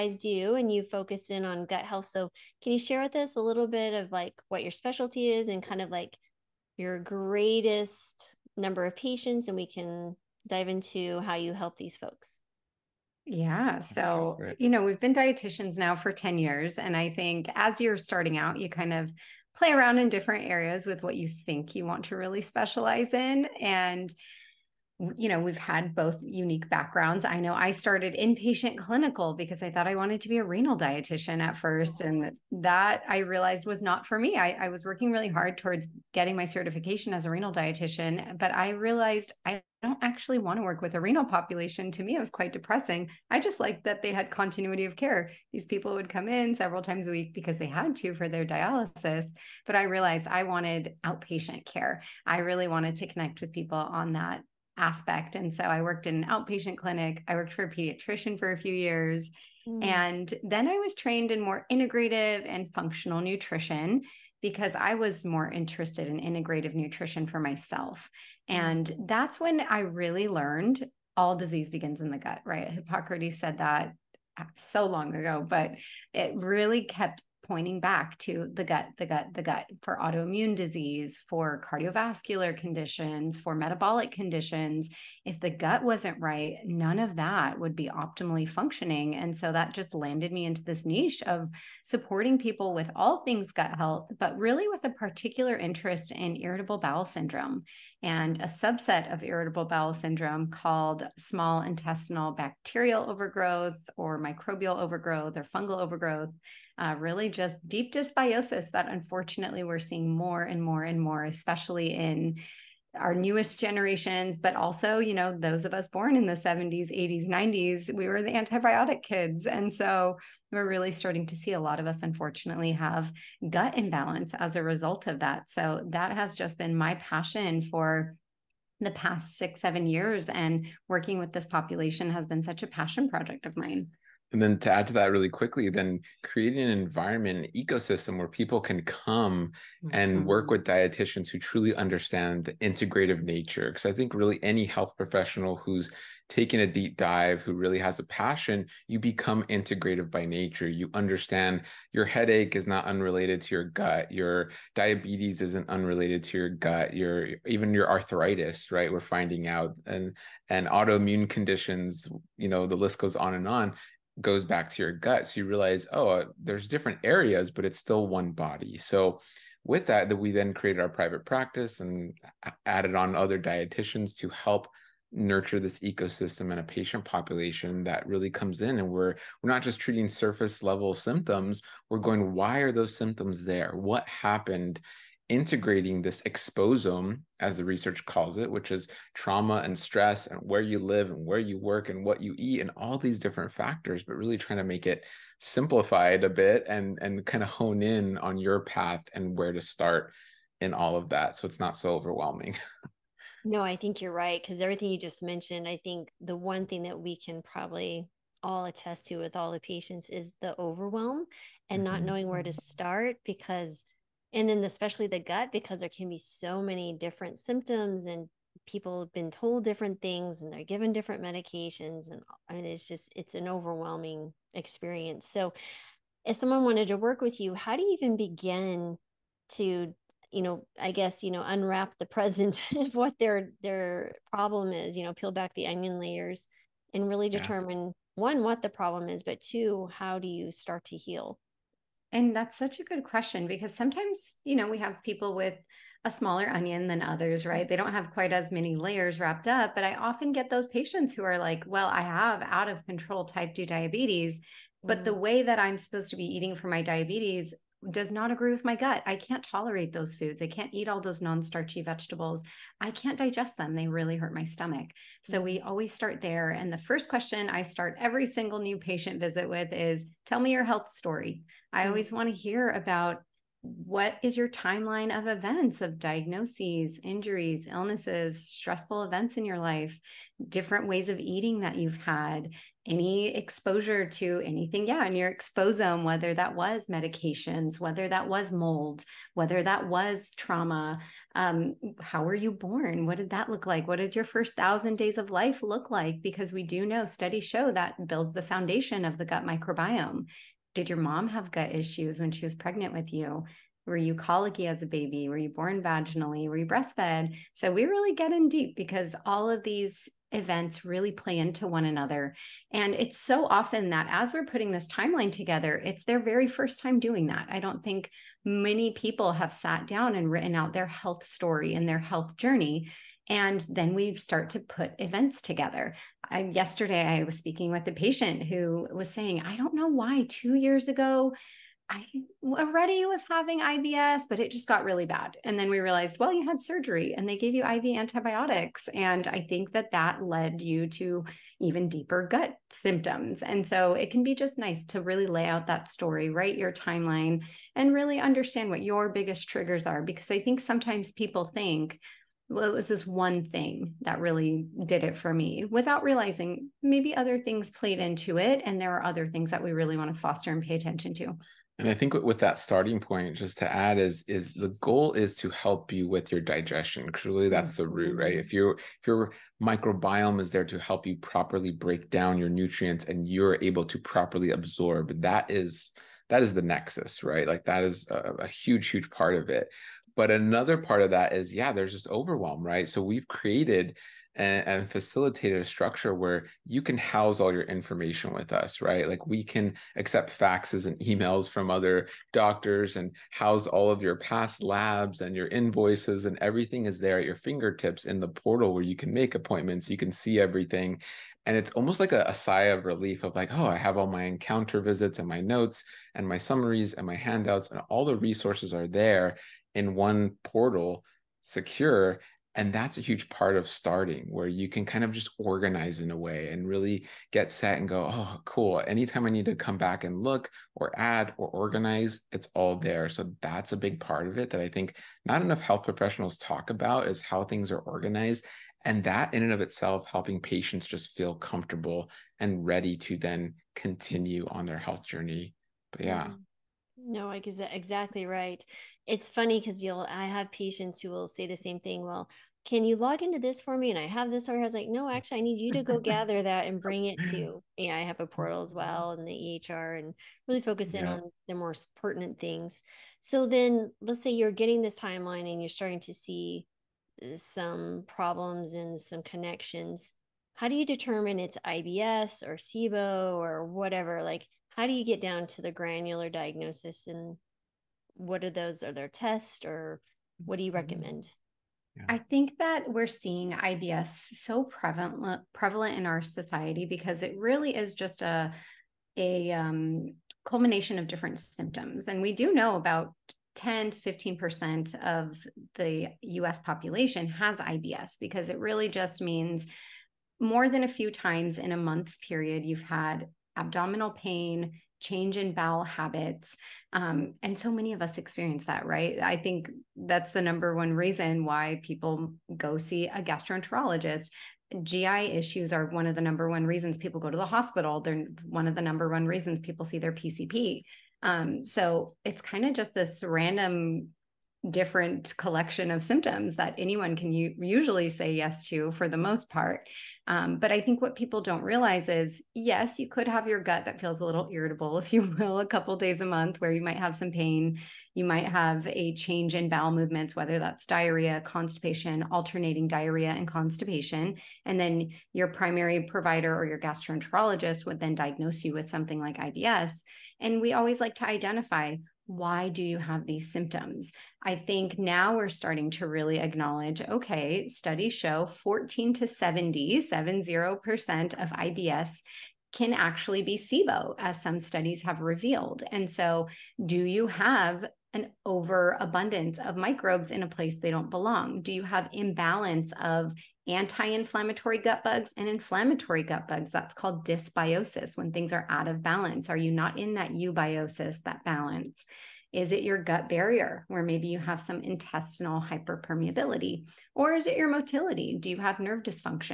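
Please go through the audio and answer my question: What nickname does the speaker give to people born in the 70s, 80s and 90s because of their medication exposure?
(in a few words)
The antibiotic kids.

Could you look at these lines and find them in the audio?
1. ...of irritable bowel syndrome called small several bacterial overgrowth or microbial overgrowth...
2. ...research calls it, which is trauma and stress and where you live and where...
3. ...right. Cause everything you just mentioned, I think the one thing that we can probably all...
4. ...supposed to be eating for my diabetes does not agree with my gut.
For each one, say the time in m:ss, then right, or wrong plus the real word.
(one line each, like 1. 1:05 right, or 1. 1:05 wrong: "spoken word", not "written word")
1. 1:39 wrong: "intestinal", not "several"
2. 3:07 right
3. 3:24 right
4. 4:15 right.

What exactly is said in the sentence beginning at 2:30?
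You understand your headache is not unrelated to your gut, your diabetes isn't unrelated to your gut, your even your arthritis, right?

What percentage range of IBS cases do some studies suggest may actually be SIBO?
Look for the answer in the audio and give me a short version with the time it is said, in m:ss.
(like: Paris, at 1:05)
14 to 70%, at 9:08.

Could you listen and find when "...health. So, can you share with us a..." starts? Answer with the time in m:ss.
0:01.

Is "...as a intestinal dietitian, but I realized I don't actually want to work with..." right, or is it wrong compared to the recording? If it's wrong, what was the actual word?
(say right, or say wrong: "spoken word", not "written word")
wrong: "renal", not "intestinal".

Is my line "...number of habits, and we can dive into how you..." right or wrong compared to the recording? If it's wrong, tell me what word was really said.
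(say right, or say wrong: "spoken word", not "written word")
wrong: "patients", not "habits".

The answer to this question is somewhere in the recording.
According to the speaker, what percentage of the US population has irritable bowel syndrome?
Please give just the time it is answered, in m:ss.
8:03.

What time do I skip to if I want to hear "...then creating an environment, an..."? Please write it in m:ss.
2:15.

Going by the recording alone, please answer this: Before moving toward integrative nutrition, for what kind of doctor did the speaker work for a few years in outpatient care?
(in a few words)
A pediatrician.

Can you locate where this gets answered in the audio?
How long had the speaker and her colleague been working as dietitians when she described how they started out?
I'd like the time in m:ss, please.
0:16.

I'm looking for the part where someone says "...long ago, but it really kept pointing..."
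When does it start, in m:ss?
1:14.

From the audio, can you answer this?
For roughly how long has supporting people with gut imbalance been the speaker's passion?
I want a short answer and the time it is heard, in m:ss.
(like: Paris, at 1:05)
6-7 years, at 2:09.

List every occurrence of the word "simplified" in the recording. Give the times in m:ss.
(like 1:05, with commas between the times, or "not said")
3:15.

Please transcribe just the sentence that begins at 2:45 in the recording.
So you realize, oh, uh, there's different areas, but it's still one body.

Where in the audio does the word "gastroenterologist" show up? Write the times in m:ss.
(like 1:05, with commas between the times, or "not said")
8:23, 8:56.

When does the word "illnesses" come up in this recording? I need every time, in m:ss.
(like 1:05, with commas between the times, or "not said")
4:37.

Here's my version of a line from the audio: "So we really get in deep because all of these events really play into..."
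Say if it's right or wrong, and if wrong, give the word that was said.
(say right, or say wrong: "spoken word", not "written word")
right.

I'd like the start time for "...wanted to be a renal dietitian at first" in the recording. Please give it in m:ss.
0:29.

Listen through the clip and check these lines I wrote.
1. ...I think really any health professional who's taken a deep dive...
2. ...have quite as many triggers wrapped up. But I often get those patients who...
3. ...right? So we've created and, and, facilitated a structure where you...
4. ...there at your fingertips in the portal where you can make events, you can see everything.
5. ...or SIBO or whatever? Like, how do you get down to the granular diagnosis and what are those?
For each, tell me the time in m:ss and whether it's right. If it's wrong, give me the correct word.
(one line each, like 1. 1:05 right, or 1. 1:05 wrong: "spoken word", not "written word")
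1. 2:23 right
2. 4:07 wrong: "layers", not "triggers"
3. 6:22 right
4. 6:36 wrong: "appointments", not "events"
5. 7:42 right.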